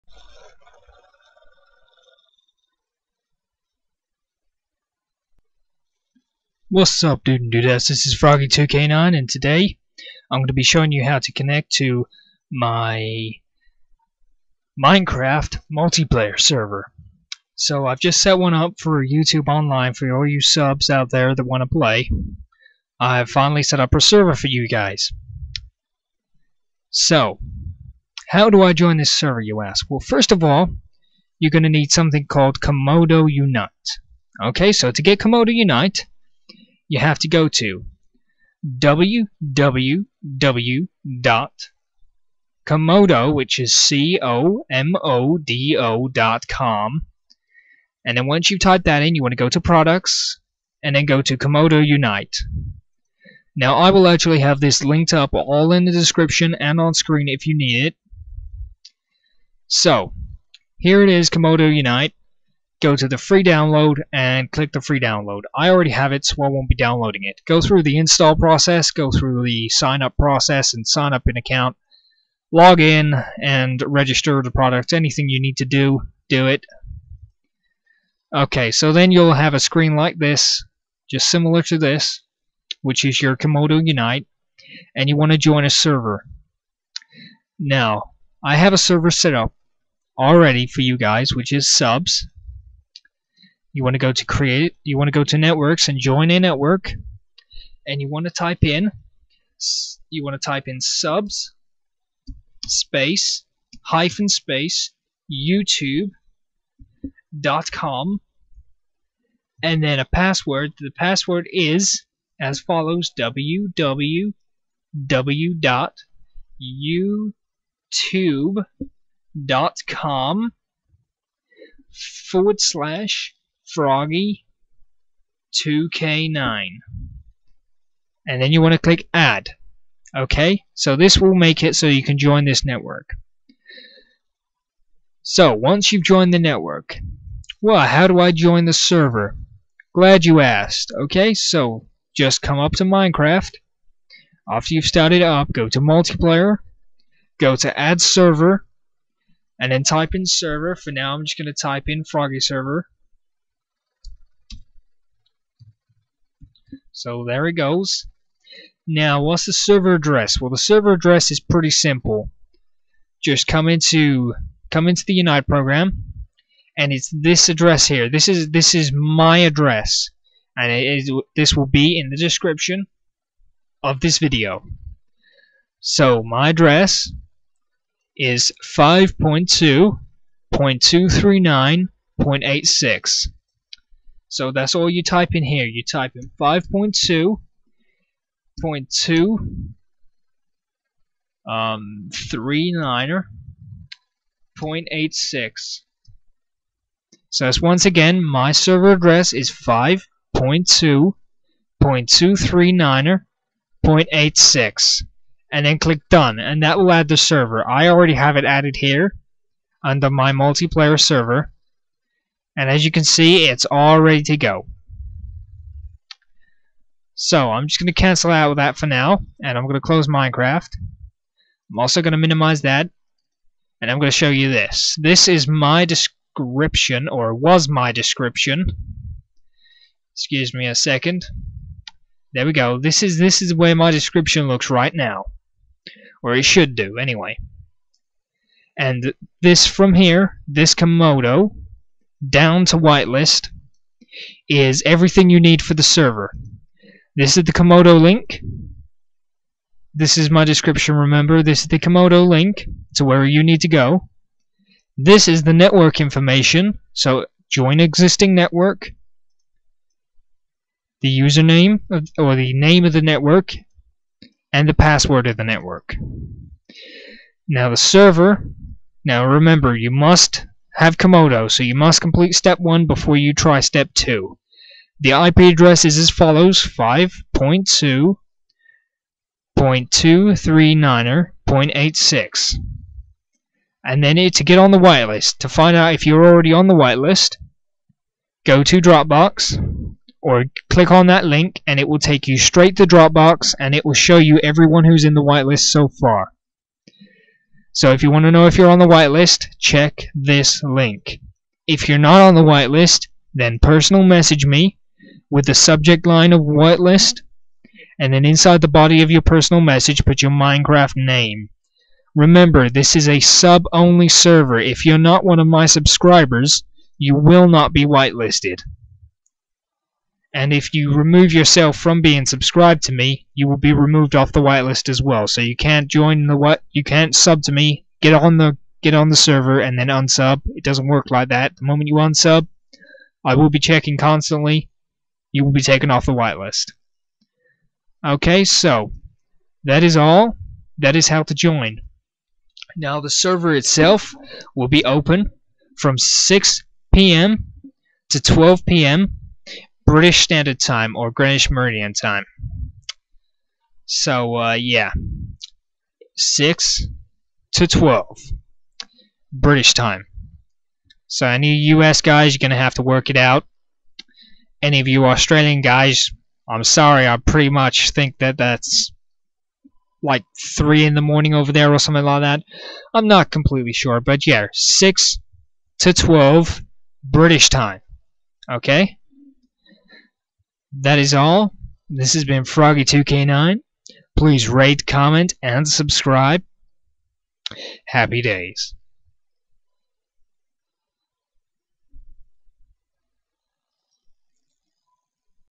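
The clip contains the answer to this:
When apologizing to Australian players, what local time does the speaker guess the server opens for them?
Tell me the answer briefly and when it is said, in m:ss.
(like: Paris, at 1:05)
3 in the morning, at 6:10.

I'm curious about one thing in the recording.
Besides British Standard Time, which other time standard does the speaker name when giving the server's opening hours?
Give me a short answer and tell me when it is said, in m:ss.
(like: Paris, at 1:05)
Greenwich Meridian Time, at 5:51.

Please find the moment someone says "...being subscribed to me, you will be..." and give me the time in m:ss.
5:22.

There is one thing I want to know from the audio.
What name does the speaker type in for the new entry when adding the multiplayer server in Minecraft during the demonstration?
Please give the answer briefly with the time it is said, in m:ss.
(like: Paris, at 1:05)
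Froggy server, at 2:32.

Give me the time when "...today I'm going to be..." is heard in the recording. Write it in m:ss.
0:09.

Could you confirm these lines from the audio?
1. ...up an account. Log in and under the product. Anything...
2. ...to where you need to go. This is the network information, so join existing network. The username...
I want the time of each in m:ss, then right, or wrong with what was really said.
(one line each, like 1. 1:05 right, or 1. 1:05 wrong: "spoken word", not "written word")
1. 1:11 wrong: "register", not "under"
2. 4:12 right.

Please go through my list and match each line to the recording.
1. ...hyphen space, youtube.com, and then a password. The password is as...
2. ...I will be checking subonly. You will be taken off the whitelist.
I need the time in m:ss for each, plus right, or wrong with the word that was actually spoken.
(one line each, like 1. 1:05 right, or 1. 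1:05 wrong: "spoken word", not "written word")
1. 1:43 right
2. 5:33 wrong: "constantly", not "subonly".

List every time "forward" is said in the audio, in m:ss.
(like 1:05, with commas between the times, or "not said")
2:02.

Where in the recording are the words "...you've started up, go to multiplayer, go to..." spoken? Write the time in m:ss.
2:24.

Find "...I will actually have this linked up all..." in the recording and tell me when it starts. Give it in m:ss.
0:53.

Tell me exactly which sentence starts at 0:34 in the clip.
Okay, so to get Comodo Unite, you have to go to www.comodo, which is C-O-M-O-D-O dot com.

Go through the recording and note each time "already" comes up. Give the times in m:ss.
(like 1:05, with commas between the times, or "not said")
1:05, 1:30, 3:27, 4:46.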